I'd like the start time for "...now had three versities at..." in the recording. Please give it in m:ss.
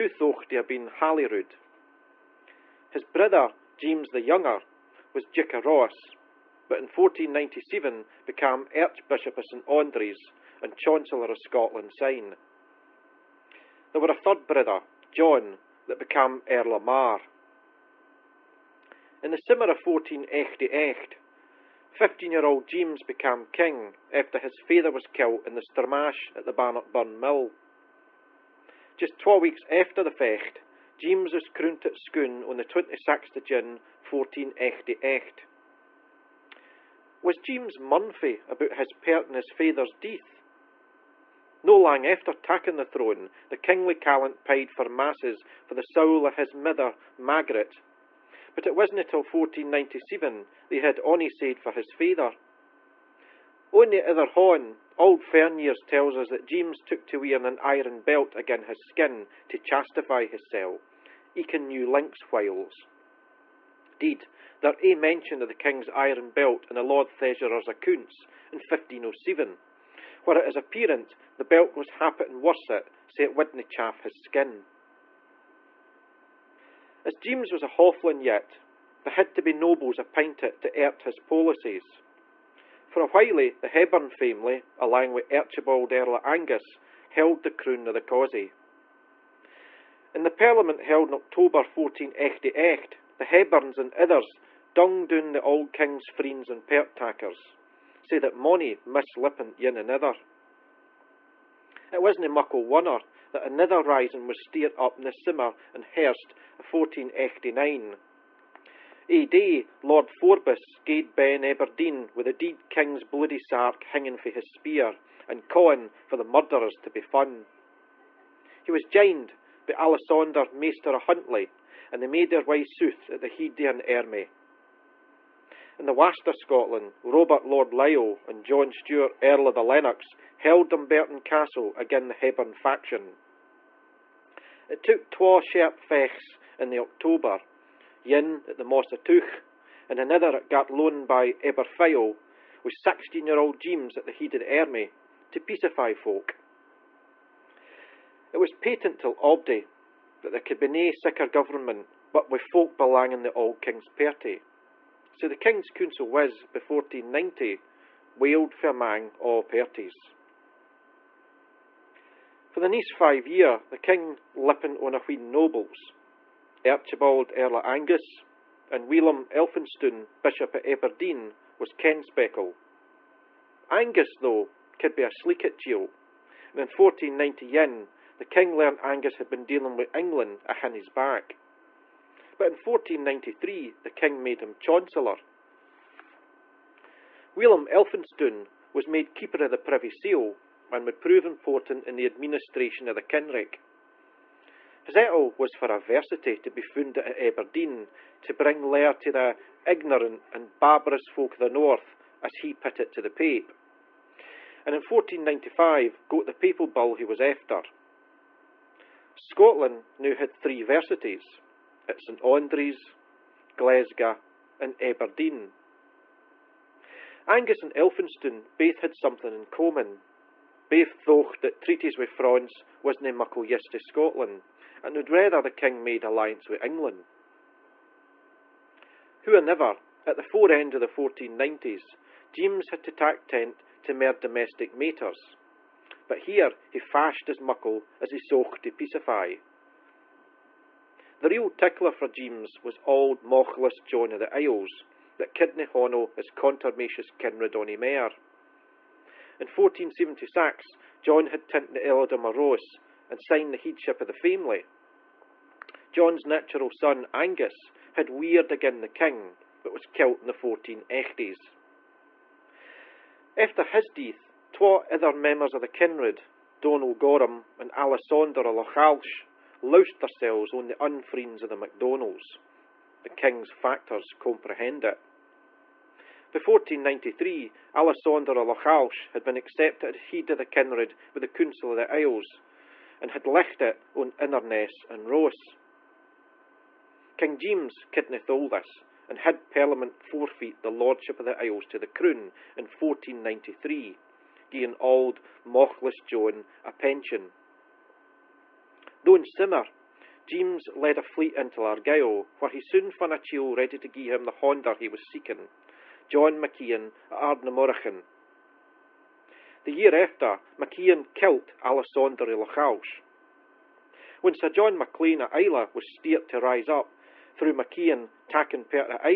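3:29.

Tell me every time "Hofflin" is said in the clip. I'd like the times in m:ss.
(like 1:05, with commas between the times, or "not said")
1:17.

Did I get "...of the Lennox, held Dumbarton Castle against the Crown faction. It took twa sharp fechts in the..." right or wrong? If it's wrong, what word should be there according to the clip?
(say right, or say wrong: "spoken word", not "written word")
wrong: "Hepburn", not "Crown".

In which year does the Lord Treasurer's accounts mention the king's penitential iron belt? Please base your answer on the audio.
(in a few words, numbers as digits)
1507.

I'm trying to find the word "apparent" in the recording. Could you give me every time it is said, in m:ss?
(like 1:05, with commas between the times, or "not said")
1:10.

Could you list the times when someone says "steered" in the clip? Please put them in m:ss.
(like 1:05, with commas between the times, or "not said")
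1:44, 5:15.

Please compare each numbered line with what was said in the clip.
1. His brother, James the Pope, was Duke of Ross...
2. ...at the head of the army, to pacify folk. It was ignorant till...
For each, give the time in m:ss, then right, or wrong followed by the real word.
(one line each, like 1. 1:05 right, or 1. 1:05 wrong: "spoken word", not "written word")
1. 0:02 wrong: "Younger", not "Pope"
2. 2:23 wrong: "patent", not "ignorant".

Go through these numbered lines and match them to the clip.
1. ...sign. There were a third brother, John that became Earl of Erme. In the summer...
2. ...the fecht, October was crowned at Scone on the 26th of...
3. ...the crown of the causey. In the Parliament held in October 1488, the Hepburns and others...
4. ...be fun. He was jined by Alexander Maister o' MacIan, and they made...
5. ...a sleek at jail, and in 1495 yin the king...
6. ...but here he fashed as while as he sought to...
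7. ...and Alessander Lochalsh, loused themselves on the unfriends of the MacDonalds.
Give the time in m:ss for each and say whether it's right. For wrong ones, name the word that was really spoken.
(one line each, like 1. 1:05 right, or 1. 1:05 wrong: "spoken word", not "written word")
1. 0:11 wrong: "Mar", not "Erme"
2. 0:30 wrong: "James", not "October"
3. 1:27 right
4. 1:56 wrong: "Huntly", not "MacIan"
5. 2:55 wrong: "1490", not "1495"
6. 3:56 wrong: "muckle", not "while"
7. 4:27 right.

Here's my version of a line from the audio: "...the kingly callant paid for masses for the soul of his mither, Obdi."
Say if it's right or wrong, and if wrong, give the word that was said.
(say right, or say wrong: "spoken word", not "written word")
wrong: "Margaret", not "Obdi".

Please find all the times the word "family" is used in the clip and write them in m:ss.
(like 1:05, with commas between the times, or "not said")
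1:24, 4:14.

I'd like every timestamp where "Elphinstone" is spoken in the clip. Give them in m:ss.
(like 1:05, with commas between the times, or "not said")
2:49, 3:07, 3:37.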